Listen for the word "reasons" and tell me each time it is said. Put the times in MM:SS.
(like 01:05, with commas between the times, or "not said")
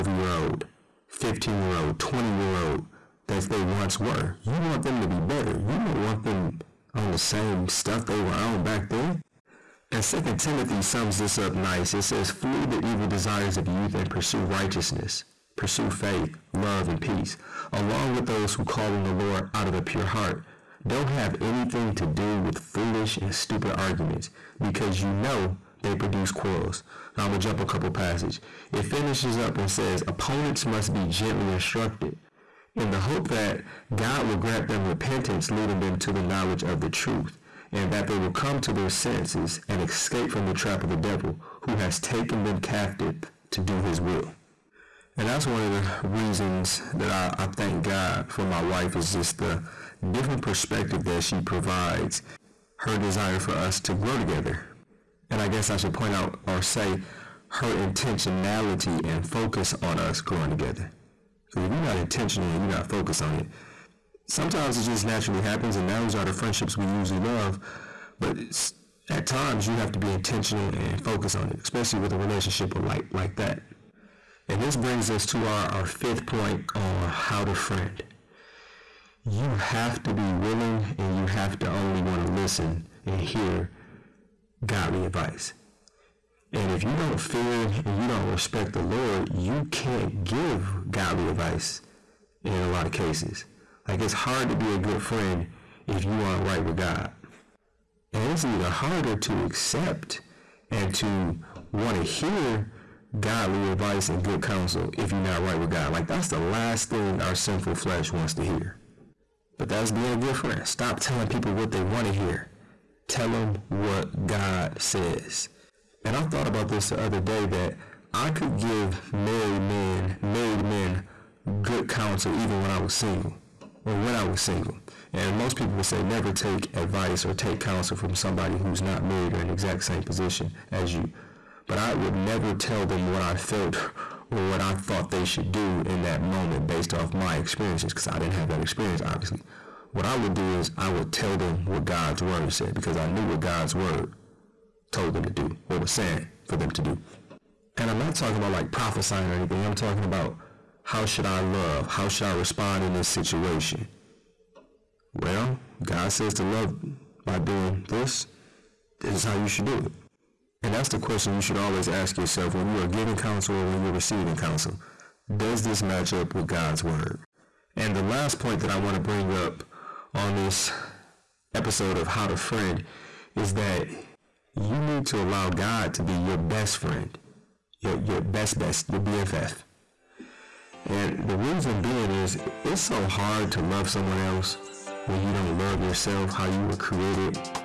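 00:46, 03:01.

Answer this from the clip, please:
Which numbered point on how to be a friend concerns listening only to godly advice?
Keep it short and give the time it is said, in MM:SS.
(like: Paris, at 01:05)
Fifth, at 01:15.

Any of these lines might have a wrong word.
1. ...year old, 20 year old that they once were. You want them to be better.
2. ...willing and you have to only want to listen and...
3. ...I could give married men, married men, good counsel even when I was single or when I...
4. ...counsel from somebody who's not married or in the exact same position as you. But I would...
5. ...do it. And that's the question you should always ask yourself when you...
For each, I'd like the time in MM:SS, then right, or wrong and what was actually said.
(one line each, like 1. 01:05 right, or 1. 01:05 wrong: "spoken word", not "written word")
1. 00:01 right
2. 01:20 right
3. 01:58 right
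4. 02:07 right
5. 02:39 right.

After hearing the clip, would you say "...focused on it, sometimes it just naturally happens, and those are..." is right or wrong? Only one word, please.
right.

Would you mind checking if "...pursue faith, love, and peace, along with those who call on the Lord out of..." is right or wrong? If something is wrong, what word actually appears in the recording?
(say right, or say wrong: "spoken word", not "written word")
right.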